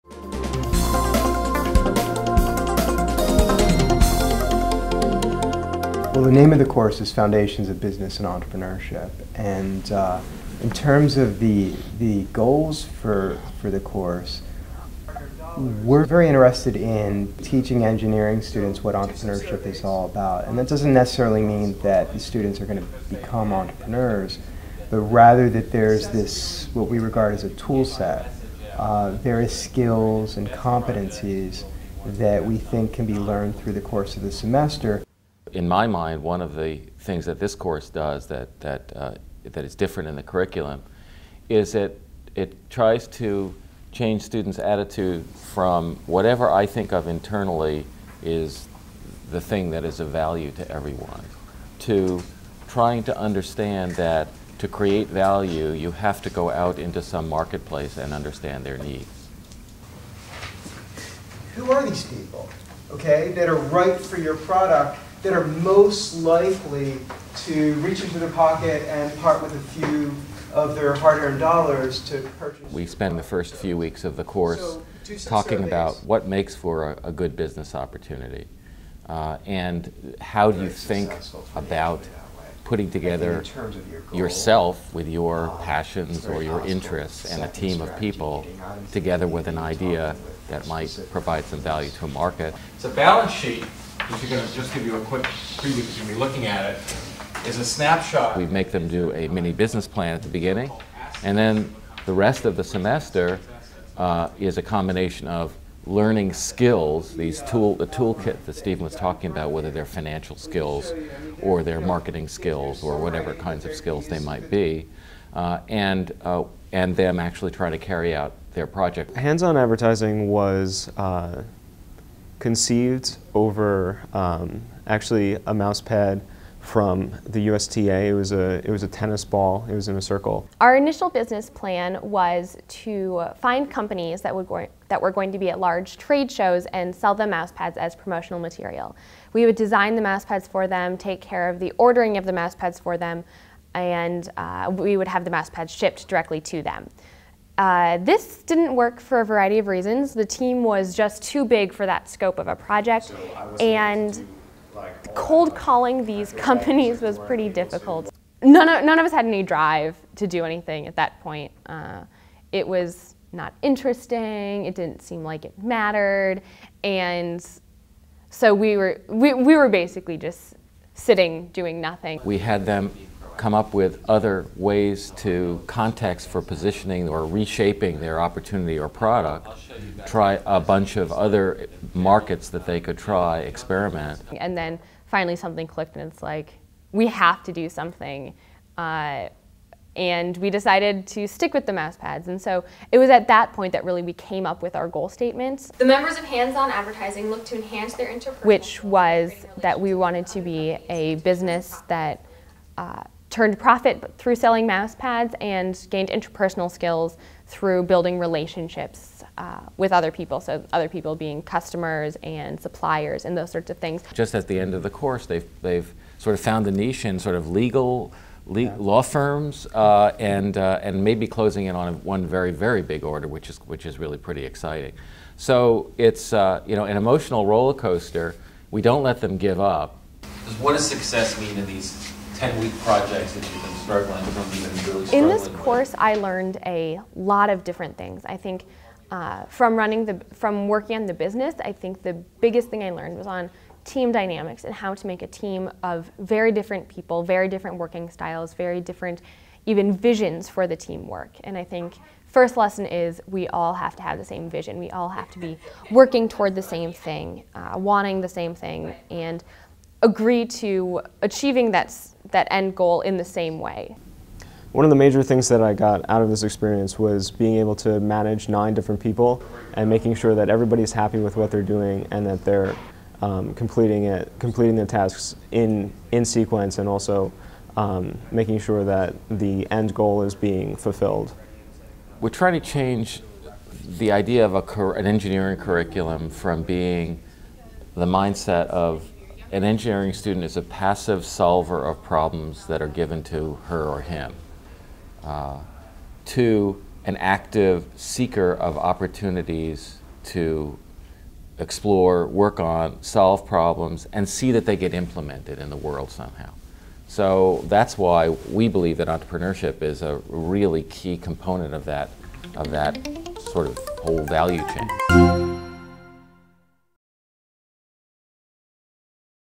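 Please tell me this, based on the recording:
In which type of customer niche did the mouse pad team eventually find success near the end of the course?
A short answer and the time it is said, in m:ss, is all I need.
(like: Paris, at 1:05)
Law firms, at 3:38.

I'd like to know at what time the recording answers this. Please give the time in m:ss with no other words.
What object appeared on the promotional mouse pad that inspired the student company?
2:08.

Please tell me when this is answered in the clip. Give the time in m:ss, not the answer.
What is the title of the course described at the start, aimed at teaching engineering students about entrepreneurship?
0:07.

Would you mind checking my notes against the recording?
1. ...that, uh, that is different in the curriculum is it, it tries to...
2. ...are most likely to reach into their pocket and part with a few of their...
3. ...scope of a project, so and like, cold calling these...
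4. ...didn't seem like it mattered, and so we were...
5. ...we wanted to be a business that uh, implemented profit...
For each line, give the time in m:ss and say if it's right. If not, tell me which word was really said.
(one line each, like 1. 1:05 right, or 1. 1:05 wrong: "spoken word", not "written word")
1. 0:38 right
2. 1:05 right
3. 2:32 right
4. 2:44 right
5. 3:19 wrong: "turned", not "implemented".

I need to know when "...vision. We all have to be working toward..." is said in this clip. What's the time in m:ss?
4:14.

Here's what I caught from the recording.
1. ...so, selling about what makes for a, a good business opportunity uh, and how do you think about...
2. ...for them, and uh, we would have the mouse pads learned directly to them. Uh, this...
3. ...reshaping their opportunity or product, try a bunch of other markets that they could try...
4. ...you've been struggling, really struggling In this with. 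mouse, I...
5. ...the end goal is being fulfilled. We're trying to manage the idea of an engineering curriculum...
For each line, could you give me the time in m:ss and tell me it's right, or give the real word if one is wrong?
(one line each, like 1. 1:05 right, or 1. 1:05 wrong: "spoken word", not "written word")
1. 1:15 wrong: "talking", not "selling"
2. 2:22 wrong: "shipped", not "learned"
3. 2:57 right
4. 3:53 wrong: "course", not "mouse"
5. 4:39 wrong: "change", not "manage".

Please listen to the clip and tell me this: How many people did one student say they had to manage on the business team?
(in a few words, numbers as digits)
9.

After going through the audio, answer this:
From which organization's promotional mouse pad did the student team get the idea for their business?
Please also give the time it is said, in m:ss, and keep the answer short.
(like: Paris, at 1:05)
USTA, at 2:07.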